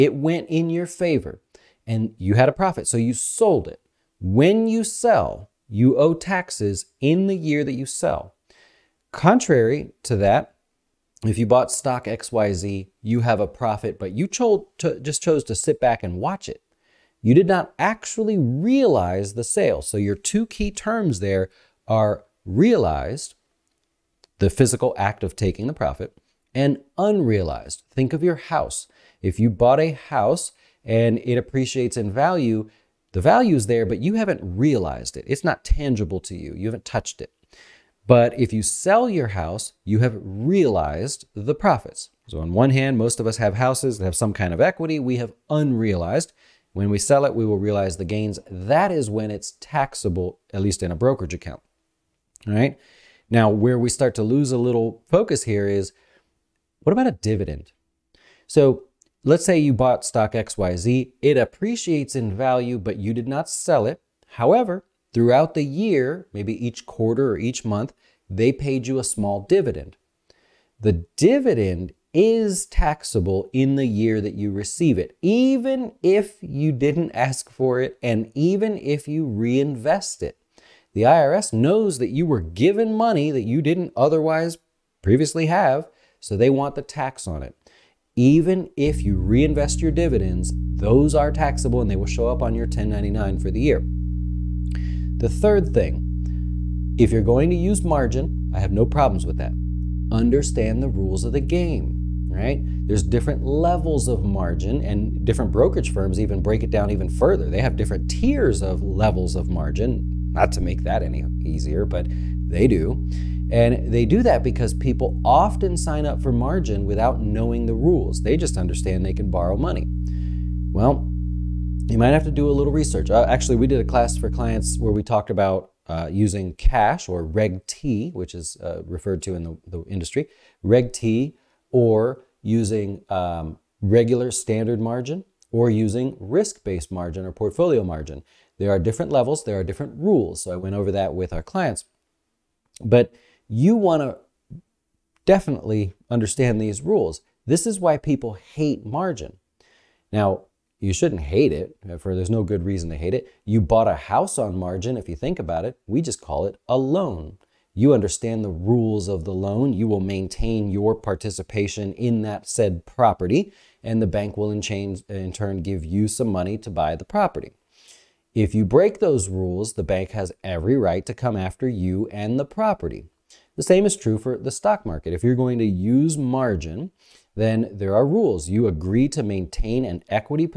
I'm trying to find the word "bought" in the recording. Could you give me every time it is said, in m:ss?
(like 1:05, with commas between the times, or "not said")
0:11, 0:29, 0:59, 2:33.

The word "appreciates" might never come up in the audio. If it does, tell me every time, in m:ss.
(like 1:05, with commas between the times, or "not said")
0:31, 1:01.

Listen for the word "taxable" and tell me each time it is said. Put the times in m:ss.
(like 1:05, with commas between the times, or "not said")
0:49, 1:12, 1:31.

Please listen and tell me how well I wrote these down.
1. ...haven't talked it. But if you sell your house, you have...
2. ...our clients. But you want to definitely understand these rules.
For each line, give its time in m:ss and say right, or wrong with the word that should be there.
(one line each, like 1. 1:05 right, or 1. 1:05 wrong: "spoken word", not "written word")
1. 0:36 wrong: "touched", not "talked"
2. 2:21 right.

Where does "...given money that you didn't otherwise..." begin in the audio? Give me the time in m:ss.
1:22.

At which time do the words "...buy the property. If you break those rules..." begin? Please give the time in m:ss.
2:46.